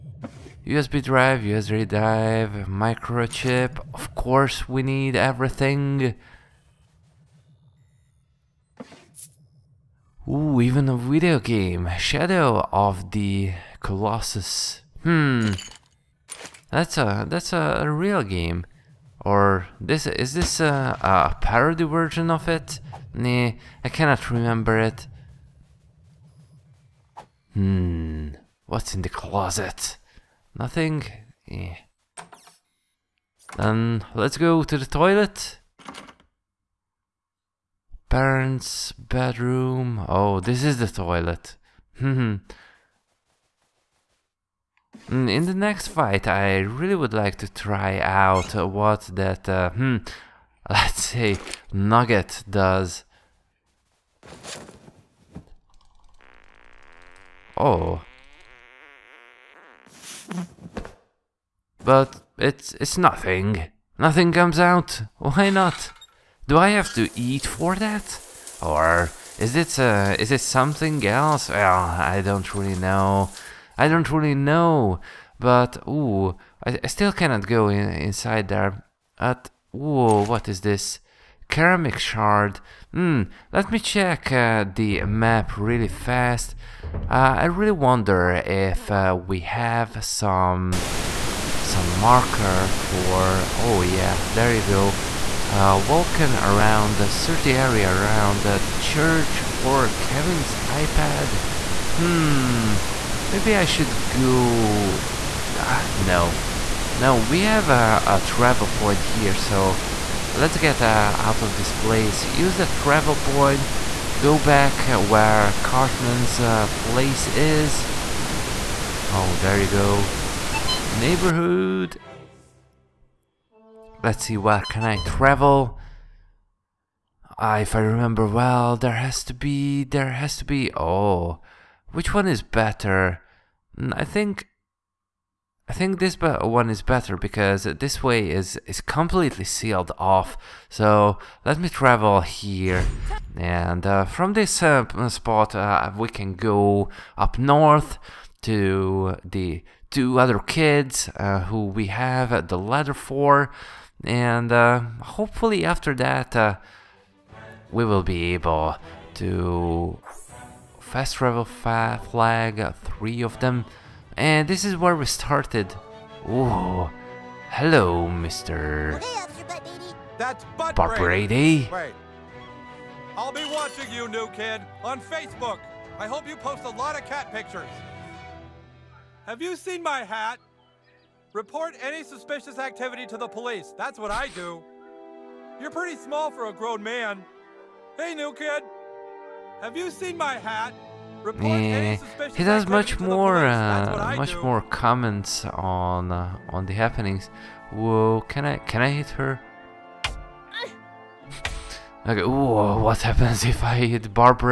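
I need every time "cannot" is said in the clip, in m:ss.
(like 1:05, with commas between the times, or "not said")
0:23, 1:17.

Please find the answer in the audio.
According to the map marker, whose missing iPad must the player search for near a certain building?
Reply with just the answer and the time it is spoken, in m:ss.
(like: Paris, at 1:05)
Kevin's, at 1:39.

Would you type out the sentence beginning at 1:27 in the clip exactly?
Uh, I really wonder if uh, we have some some marker for...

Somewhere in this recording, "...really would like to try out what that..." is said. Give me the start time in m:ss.
0:46.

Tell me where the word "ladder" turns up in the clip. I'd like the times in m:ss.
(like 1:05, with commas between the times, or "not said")
2:32.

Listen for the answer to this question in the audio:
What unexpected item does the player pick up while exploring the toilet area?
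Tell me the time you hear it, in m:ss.
1:21.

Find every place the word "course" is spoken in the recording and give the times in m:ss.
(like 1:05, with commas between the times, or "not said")
0:04.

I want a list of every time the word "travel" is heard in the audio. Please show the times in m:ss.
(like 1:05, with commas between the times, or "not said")
1:48, 1:52, 2:05, 2:21, 2:41.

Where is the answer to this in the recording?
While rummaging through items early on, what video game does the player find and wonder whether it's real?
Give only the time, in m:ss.
0:11.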